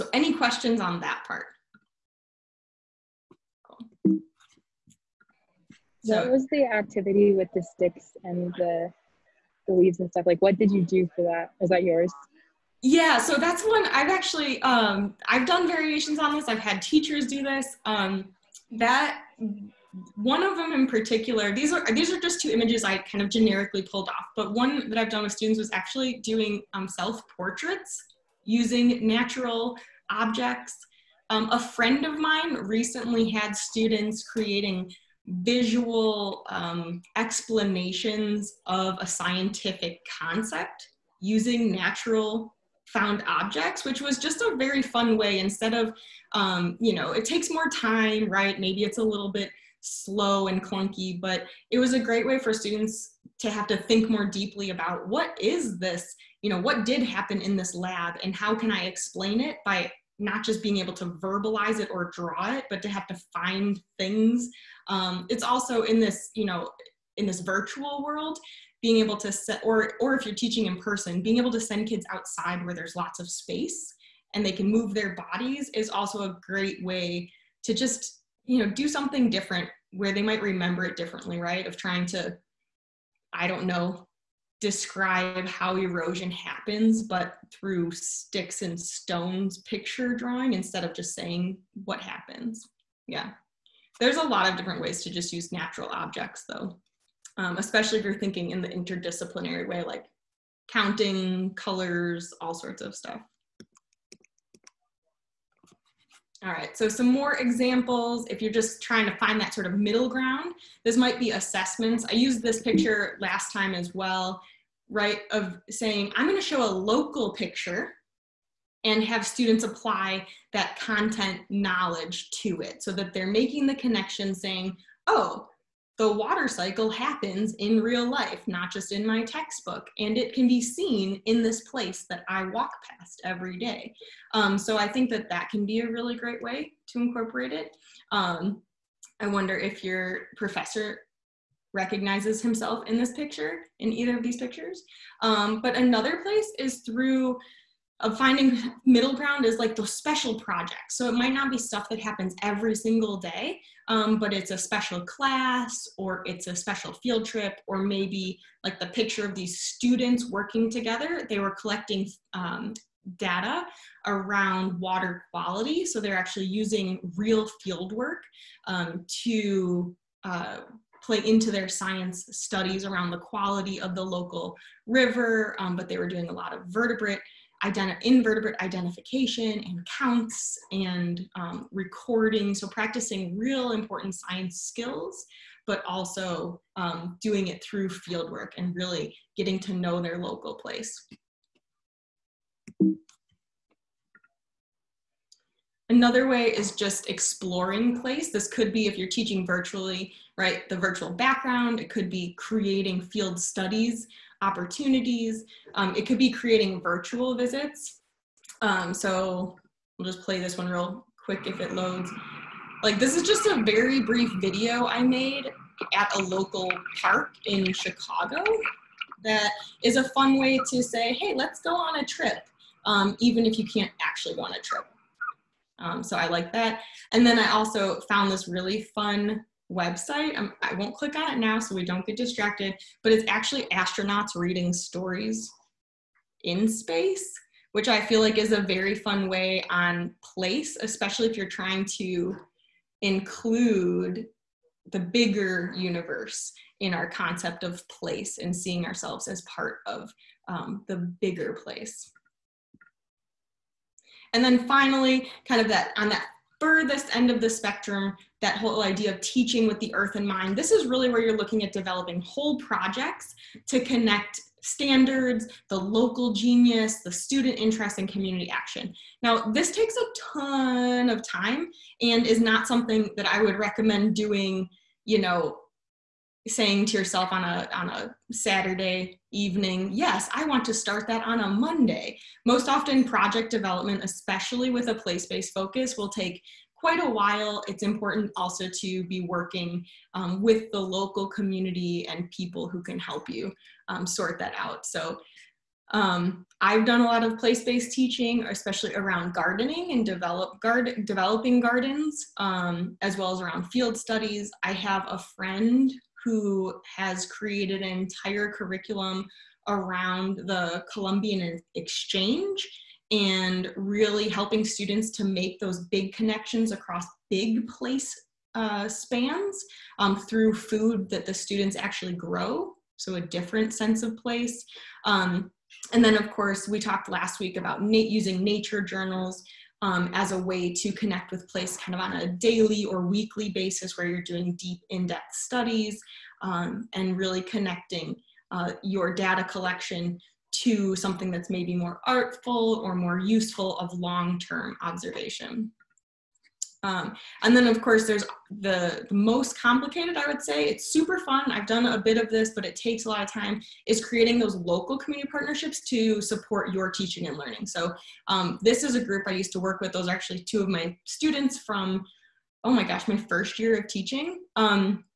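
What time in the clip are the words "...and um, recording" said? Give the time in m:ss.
3:00.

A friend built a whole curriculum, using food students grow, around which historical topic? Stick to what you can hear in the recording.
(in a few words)
The Columbian exchange.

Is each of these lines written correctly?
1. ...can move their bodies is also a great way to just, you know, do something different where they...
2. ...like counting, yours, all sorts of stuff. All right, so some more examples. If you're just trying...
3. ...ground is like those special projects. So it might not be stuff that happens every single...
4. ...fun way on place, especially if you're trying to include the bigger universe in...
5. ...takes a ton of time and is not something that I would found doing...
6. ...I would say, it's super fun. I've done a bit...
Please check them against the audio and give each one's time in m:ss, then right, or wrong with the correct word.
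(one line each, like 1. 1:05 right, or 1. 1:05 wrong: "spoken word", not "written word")
1. 1:14 right
2. 1:39 wrong: "colors", not "yours"
3. 2:29 right
4. 3:58 right
5. 4:29 wrong: "recommend", not "found"
6. 5:50 right.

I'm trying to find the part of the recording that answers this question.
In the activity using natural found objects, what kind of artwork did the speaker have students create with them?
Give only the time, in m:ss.
0:26.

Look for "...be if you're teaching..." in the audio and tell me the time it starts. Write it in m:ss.
3:18.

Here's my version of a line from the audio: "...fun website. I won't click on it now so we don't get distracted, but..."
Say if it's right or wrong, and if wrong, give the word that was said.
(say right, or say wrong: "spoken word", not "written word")
right.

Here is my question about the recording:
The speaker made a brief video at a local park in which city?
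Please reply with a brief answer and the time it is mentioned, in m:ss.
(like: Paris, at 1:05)
Chicago, at 3:37.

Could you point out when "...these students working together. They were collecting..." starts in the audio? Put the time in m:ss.
2:39.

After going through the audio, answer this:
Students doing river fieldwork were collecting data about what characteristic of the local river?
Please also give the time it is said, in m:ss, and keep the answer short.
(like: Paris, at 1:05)
Water quality, at 2:44.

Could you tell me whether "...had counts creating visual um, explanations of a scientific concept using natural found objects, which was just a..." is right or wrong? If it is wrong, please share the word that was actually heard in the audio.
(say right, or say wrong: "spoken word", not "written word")
wrong: "students", not "counts".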